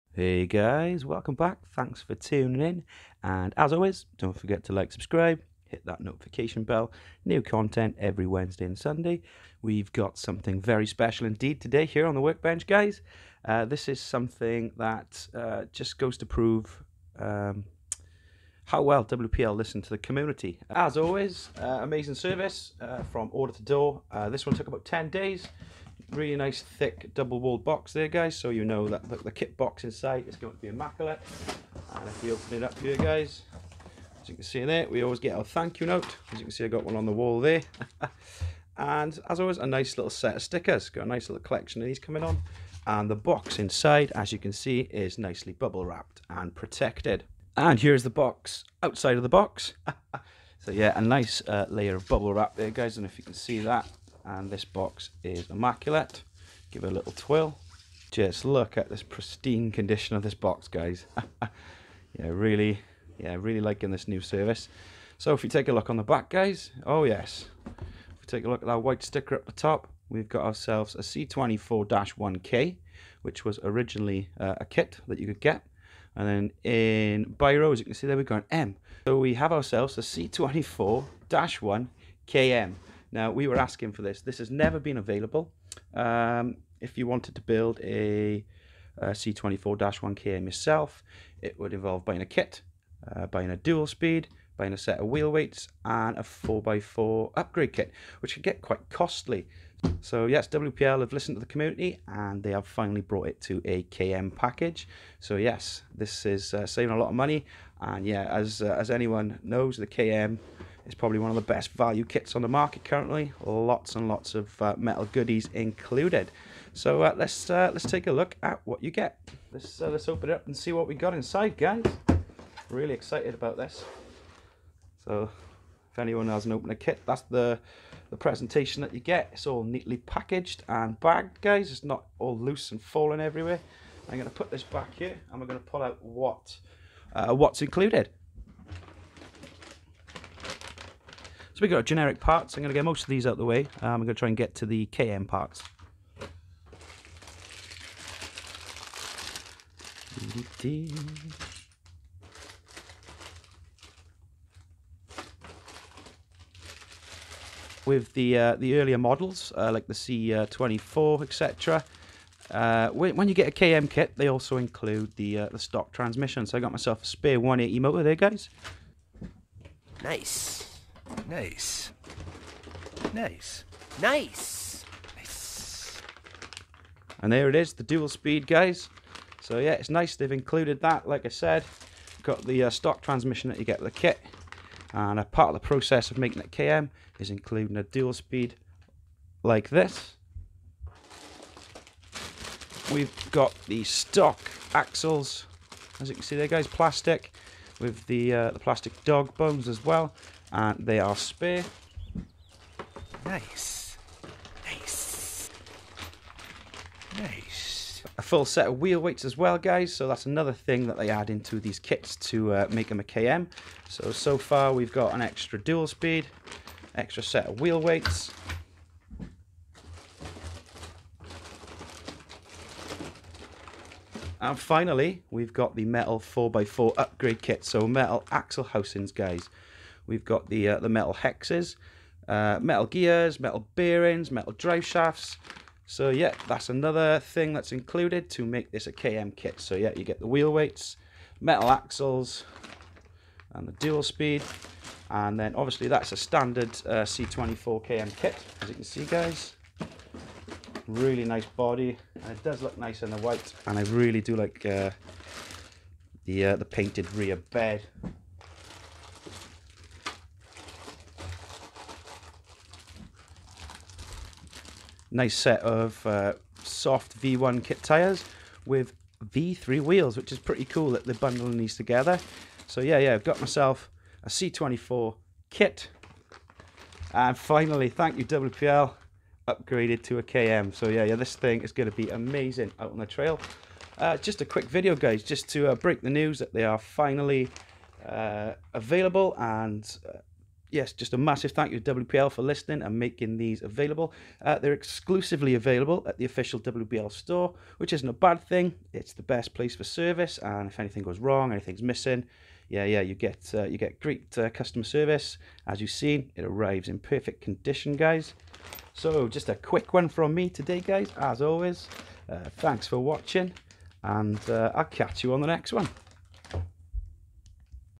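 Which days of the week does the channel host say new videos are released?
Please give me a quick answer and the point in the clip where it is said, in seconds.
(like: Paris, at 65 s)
Wednesday and Sunday, at 8 s.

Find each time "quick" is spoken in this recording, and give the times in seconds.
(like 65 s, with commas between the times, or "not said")
284 s, 309 s.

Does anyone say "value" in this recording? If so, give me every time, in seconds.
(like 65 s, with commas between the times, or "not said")
111 s.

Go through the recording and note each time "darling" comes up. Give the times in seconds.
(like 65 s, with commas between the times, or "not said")
not said.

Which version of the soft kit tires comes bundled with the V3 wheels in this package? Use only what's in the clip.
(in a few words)
V1.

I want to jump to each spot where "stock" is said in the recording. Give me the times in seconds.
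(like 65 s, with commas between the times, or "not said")
165 s, 182 s, 193 s.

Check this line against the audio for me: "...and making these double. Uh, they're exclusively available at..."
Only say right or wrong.
wrong.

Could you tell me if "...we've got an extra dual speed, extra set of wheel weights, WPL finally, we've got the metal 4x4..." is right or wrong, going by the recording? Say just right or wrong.
wrong.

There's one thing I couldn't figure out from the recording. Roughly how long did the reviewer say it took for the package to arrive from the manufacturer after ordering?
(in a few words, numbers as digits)
10 days.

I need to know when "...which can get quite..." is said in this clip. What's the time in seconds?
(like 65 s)
98 s.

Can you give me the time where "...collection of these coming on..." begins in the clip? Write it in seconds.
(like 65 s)
41 s.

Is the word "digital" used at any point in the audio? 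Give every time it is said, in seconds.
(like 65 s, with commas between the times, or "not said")
not said.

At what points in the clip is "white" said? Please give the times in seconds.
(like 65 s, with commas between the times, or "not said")
68 s, 253 s.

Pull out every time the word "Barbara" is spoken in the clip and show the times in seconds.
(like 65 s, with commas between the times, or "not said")
not said.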